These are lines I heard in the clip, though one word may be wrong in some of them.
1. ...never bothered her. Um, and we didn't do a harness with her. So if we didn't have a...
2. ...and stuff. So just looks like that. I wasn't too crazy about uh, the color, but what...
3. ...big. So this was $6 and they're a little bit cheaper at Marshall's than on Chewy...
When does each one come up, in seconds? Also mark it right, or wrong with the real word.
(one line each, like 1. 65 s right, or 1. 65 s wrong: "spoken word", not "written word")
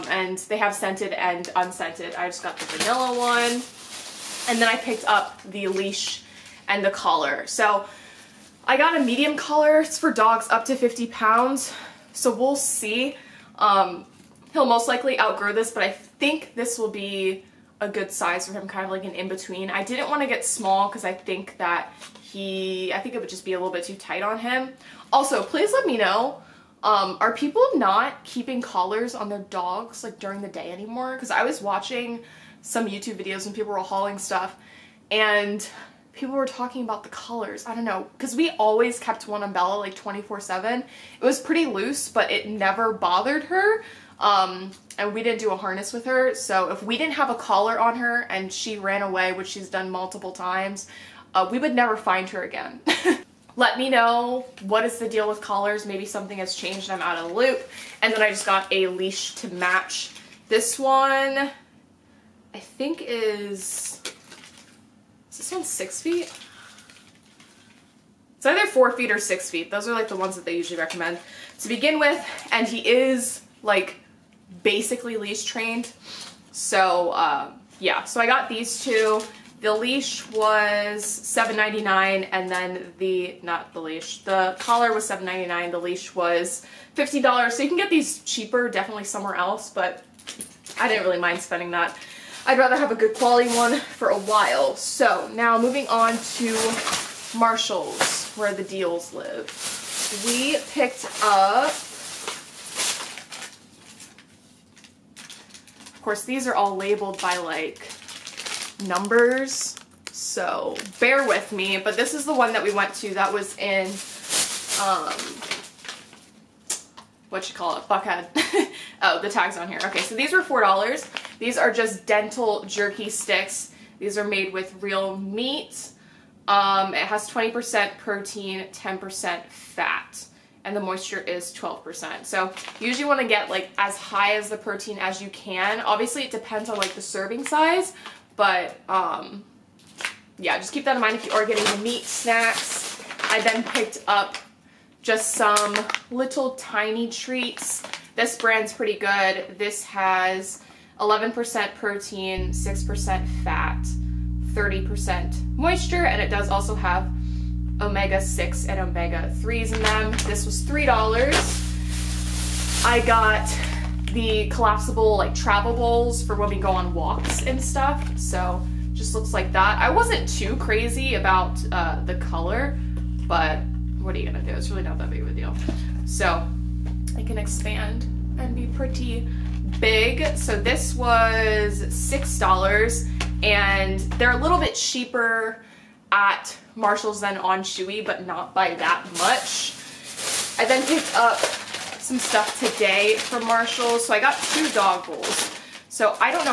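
1. 42 s right
2. 167 s right
3. 179 s right.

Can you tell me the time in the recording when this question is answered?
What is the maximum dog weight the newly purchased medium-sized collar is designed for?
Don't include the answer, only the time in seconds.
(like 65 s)
10 s.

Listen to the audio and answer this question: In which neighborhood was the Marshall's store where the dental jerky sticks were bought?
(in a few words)
Buckhead.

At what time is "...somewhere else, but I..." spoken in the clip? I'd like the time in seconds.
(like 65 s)
89 s.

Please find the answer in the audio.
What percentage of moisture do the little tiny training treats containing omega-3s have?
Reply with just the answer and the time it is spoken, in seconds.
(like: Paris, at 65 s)
30%, at 154 s.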